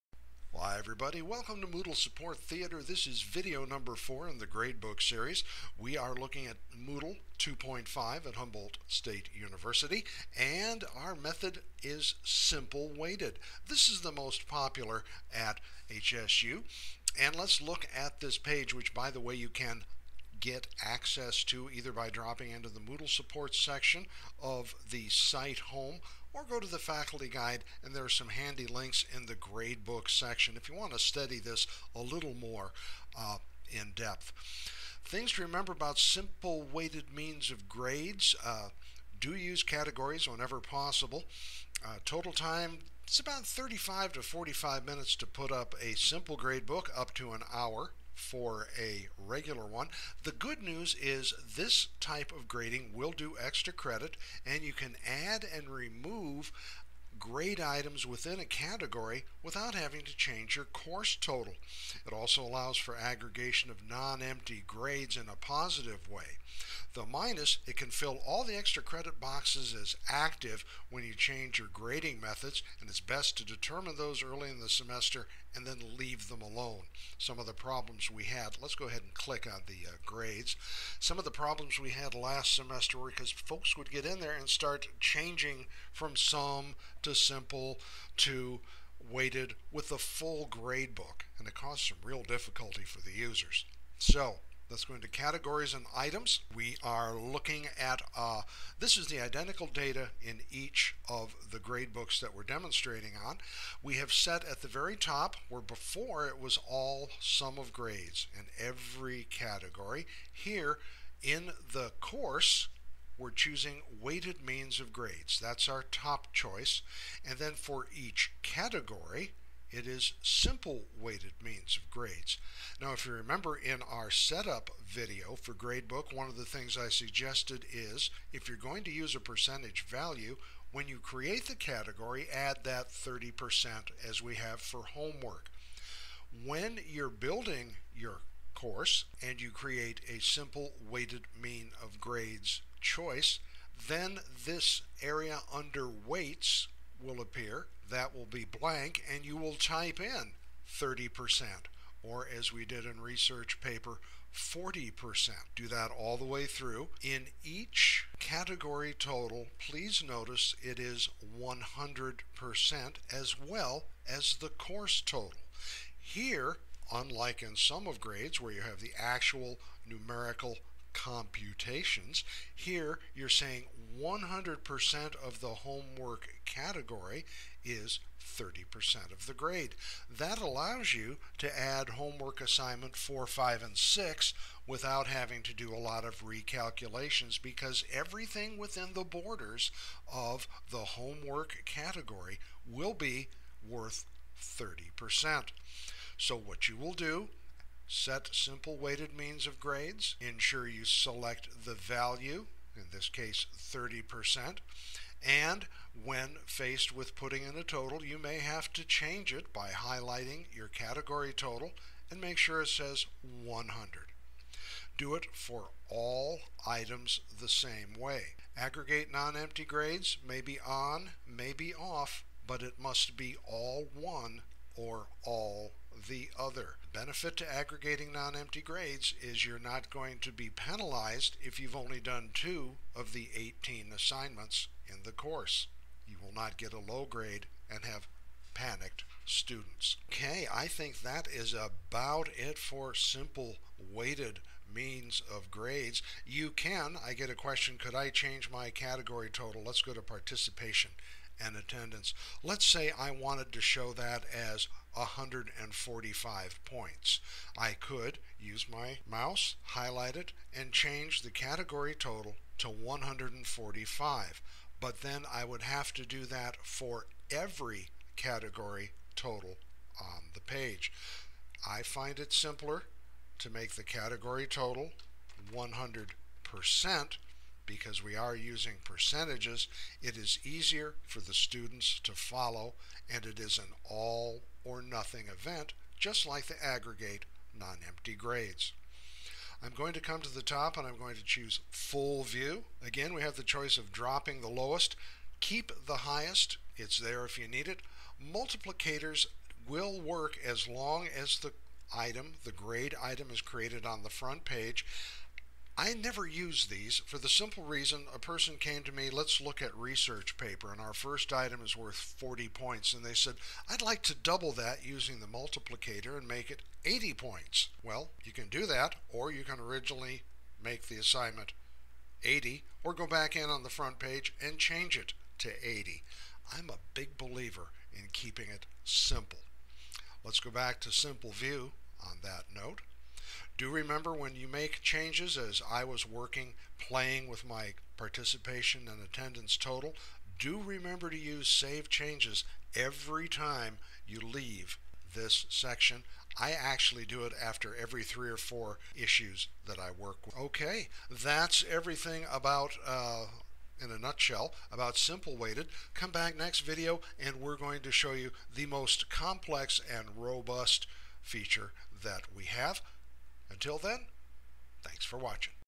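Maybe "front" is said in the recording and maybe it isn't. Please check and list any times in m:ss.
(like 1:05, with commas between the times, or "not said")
5:04, 5:23.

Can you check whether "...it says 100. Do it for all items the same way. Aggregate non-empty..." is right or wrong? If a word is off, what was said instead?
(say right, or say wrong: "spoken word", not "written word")
right.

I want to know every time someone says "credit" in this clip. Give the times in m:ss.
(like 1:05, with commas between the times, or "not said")
0:53, 1:08.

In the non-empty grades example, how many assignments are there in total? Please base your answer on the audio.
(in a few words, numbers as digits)
18.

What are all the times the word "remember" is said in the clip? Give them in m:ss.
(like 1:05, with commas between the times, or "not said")
0:35, 2:03, 5:33, 5:40.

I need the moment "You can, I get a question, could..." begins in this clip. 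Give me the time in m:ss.
4:06.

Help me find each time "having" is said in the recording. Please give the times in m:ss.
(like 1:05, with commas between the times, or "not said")
0:59, 3:05.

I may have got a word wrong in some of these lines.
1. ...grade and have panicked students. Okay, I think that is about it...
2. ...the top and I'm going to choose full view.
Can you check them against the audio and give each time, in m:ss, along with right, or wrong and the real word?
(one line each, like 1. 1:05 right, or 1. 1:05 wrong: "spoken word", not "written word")
1. 3:57 right
2. 4:50 right.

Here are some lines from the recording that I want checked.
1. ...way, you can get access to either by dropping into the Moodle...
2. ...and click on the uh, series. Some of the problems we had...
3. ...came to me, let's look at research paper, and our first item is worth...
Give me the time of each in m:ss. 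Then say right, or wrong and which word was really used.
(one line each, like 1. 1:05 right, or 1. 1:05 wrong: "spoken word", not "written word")
1. 0:19 right
2. 1:19 wrong: "grades", not "series"
3. 5:08 right.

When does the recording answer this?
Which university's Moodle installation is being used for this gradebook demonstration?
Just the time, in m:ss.
0:08.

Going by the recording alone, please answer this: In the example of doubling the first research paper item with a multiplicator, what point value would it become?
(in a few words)
80.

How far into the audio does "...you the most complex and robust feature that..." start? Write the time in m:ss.
5:58.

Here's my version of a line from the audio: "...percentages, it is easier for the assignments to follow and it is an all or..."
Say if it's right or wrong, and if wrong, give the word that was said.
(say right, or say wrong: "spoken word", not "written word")
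wrong: "students", not "assignments".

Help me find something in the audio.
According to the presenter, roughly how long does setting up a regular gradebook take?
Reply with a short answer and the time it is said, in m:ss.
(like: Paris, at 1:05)
up to an hour, at 0:46.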